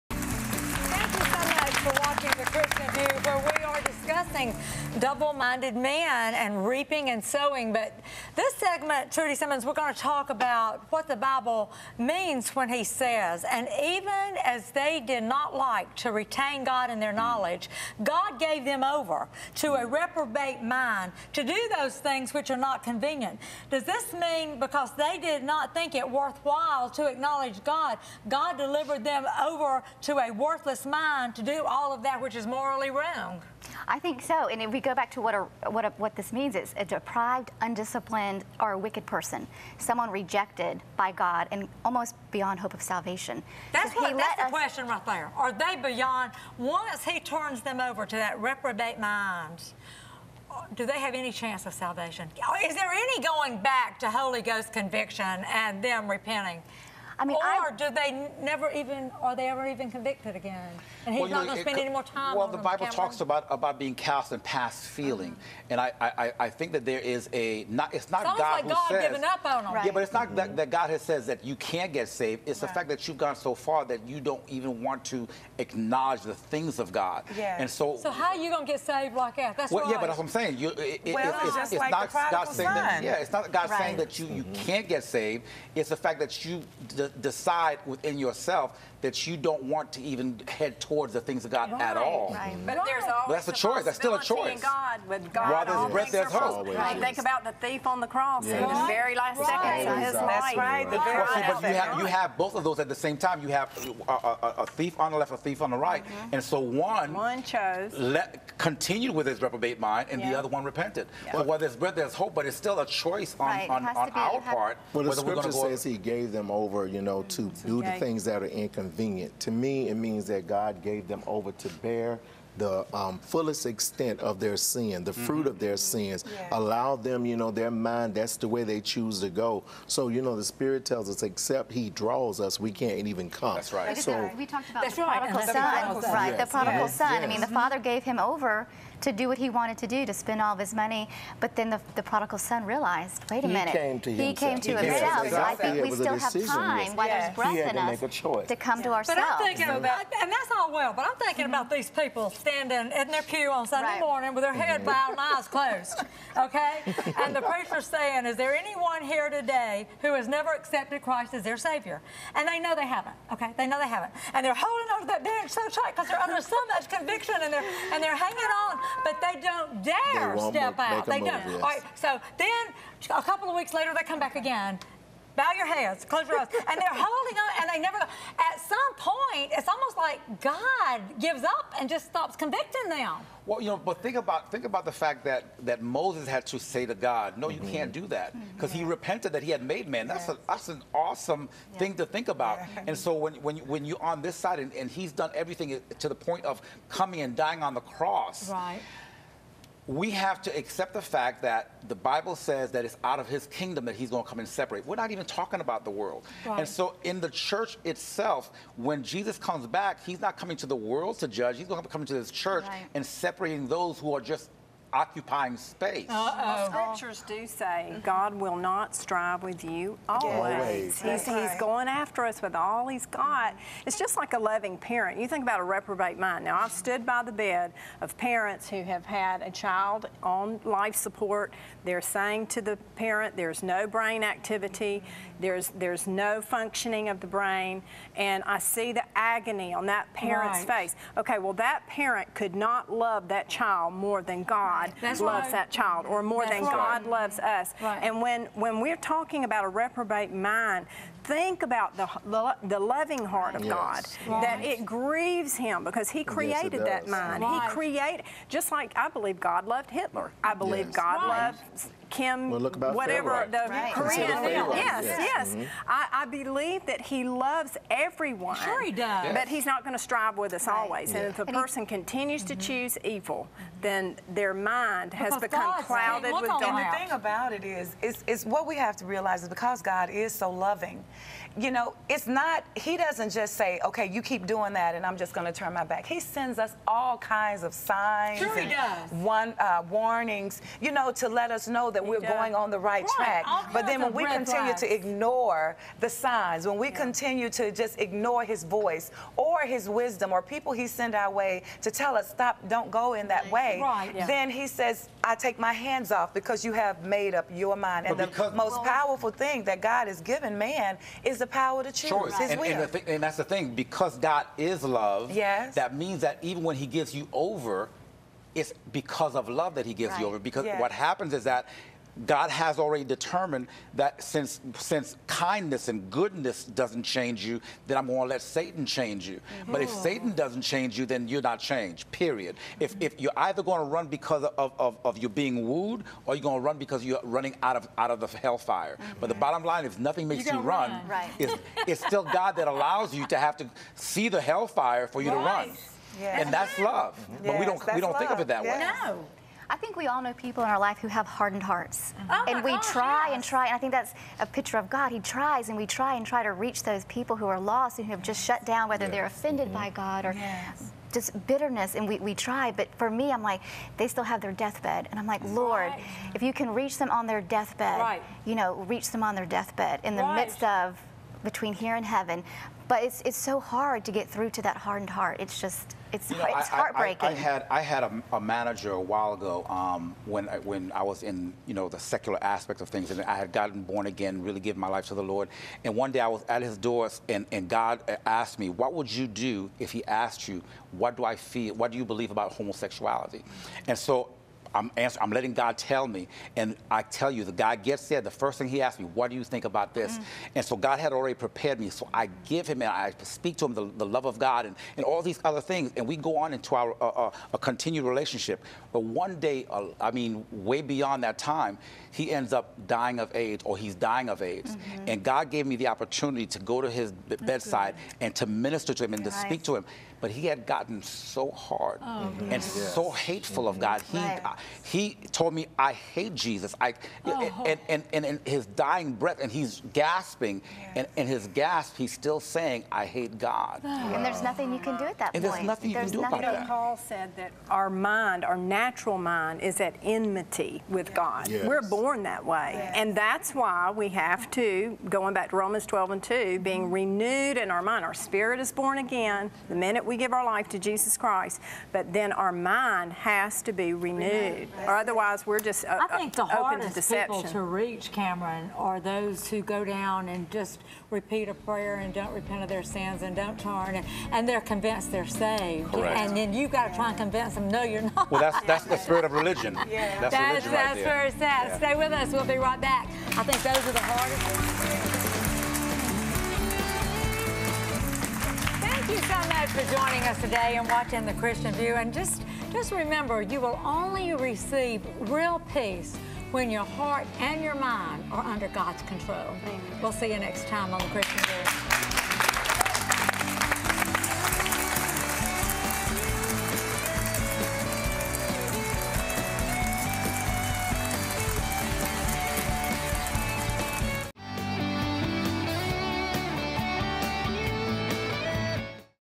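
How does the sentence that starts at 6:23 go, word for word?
And I had gotten born again, really given my life to the Lord.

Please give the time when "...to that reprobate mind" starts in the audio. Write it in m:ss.
0:48.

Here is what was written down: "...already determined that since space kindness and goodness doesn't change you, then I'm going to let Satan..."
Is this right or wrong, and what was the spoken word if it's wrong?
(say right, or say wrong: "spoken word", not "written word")
wrong: "since", not "space".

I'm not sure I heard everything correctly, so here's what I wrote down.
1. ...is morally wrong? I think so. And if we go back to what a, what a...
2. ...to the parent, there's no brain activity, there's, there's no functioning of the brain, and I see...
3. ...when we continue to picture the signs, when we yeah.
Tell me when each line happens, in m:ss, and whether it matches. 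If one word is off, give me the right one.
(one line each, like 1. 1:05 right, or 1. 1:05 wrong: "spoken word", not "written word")
1. 0:32 right
2. 3:52 right
3. 4:54 wrong: "ignore", not "picture".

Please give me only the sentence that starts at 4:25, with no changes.
I, I, believe that he loves everyone.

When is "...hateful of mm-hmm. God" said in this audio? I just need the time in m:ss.
7:03.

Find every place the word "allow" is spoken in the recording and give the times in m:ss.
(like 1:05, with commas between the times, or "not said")
2:06, 5:42.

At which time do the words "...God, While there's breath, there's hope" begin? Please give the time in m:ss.
1:35.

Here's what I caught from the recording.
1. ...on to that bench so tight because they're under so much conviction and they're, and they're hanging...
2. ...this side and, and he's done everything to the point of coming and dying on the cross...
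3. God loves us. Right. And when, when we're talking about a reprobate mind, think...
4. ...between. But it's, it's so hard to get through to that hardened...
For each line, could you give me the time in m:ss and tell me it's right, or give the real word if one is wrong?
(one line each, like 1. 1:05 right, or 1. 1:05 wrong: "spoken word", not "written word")
1. 2:44 right
2. 3:14 right
3. 4:06 right
4. 6:12 wrong: "heaven", not "between".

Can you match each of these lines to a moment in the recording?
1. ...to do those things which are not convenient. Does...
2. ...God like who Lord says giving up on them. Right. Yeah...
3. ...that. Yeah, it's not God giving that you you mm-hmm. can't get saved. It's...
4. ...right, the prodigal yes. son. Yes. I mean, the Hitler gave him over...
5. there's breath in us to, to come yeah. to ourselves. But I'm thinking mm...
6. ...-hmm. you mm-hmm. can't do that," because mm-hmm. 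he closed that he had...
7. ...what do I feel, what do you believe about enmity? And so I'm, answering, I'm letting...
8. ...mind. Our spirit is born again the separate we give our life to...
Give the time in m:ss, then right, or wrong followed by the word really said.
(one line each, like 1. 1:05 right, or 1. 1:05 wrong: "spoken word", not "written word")
1. 0:21 right
2. 1:08 wrong: "God", not "Lord"
3. 1:22 wrong: "saying", not "giving"
4. 2:16 wrong: "Father", not "Hitler"
5. 2:27 right
6. 3:07 wrong: "repented", not "closed"
7. 6:30 wrong: "homosexuality", not "enmity"
8. 7:27 wrong: "minute", not "separate".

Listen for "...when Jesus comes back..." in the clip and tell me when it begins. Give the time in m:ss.
3:28.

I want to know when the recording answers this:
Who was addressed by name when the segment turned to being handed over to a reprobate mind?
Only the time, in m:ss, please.
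0:09.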